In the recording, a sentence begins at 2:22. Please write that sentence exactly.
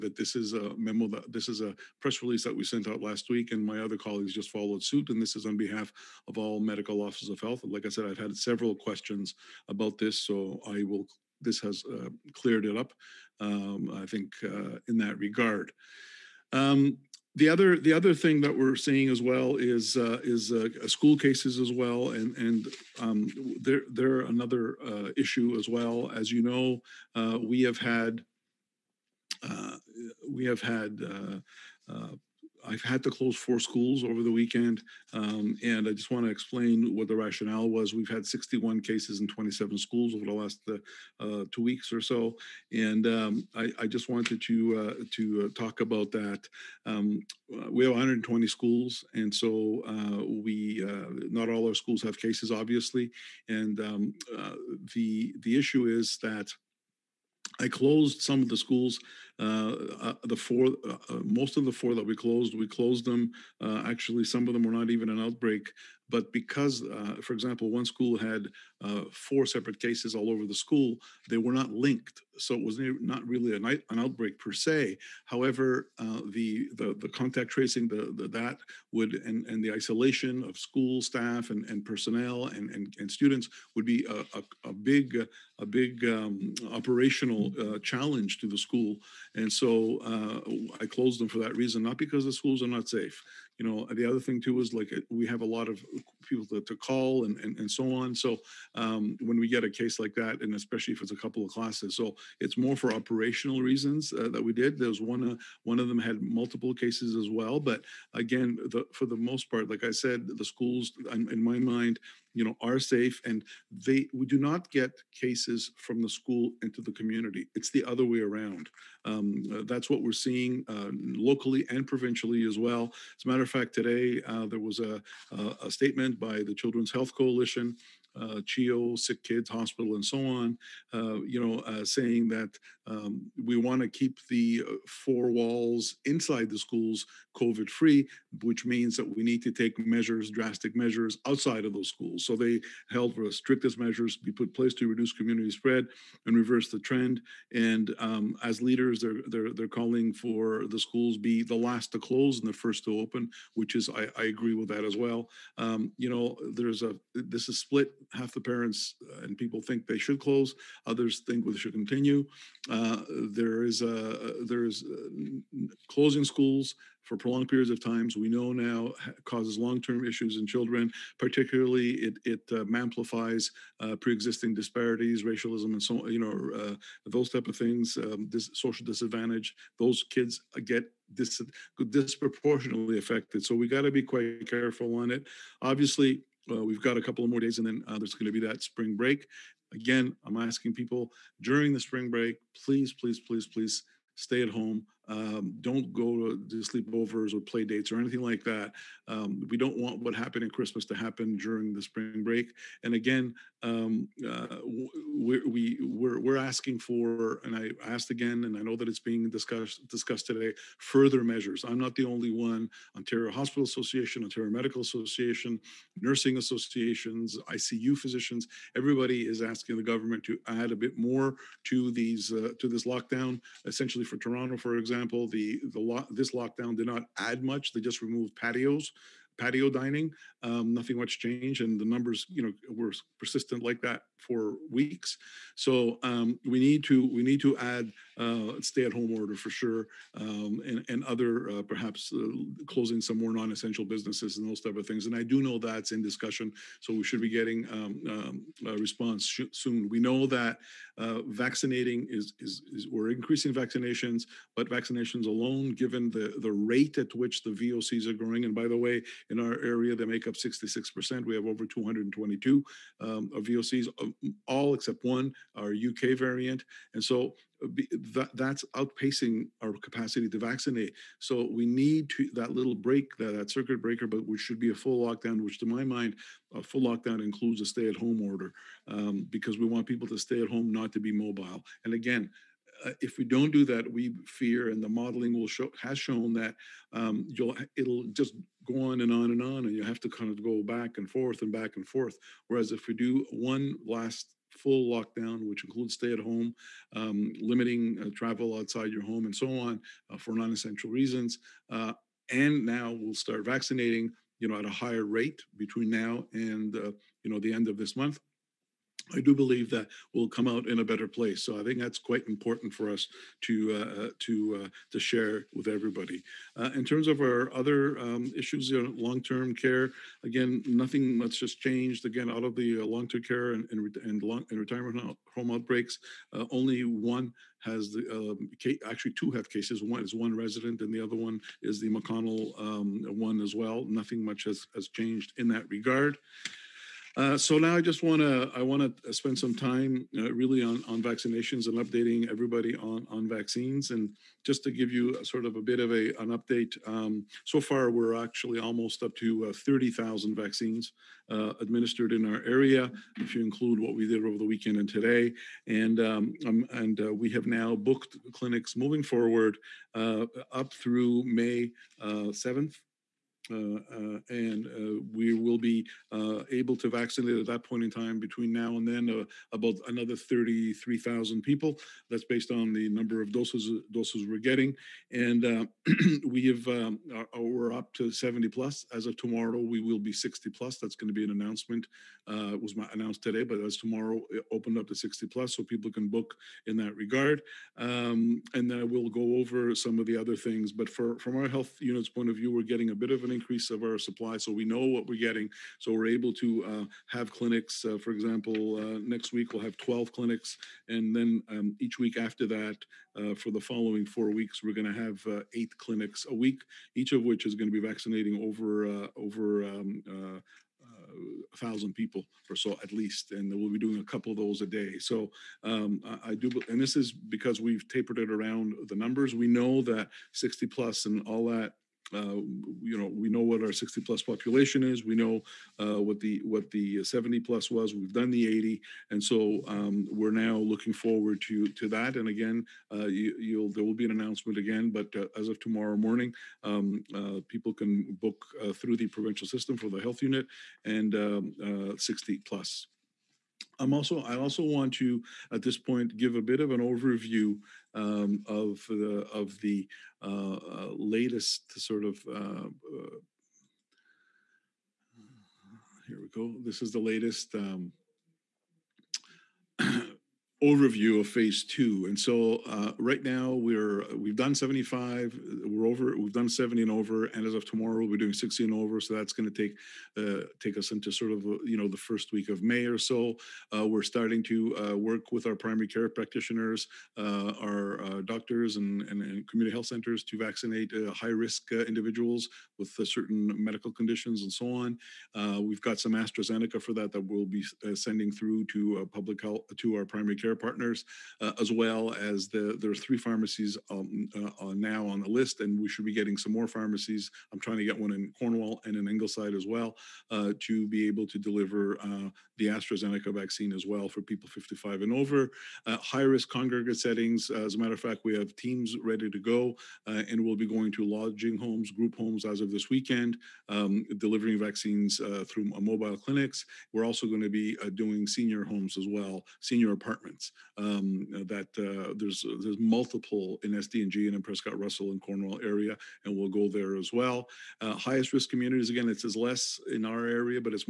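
So they held for the strictest measures be put place to reduce community spread and reverse the trend.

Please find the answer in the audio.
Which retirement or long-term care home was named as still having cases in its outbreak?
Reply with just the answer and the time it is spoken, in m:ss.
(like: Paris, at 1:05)
McConnell, at 5:31.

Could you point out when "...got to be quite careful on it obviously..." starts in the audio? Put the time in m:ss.
3:03.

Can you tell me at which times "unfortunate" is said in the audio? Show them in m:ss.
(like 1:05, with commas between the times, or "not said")
not said.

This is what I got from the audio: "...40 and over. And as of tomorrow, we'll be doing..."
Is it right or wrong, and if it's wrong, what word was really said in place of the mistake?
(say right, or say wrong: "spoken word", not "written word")
wrong: "70", not "40".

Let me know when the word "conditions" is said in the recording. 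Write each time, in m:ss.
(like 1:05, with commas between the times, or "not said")
8:03.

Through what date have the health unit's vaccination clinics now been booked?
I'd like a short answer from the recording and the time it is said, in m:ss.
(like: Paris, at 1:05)
May 7, at 6:01.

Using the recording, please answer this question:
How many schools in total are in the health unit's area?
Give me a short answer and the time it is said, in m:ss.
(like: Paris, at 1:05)
120, at 0:47.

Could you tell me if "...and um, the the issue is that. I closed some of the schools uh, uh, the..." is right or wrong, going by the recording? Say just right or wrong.
right.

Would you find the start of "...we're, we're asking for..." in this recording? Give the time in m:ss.
3:25.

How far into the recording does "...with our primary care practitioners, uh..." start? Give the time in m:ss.
7:55.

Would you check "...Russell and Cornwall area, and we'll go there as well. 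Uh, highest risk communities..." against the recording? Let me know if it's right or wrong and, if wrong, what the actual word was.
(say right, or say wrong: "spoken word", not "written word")
right.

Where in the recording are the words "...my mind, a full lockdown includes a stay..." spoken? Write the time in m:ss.
4:35.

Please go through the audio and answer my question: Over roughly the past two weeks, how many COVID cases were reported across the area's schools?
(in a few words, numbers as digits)
61.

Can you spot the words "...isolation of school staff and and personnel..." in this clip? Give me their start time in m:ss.
1:19.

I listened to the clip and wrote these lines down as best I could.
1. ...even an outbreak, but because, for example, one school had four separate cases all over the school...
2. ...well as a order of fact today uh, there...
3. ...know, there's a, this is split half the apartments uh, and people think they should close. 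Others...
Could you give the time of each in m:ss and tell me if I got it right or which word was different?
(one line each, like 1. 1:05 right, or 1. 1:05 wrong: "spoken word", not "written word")
1. 1:04 right
2. 2:02 wrong: "matter", not "order"
3. 2:36 wrong: "parents", not "apartments".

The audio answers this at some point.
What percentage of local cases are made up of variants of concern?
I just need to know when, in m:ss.
4:20.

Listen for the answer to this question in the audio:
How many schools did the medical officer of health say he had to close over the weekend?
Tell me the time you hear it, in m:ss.
0:33.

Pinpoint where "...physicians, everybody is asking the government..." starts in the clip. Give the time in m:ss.
3:37.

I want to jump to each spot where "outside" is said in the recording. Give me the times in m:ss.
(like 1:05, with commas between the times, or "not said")
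2:21, 4:58.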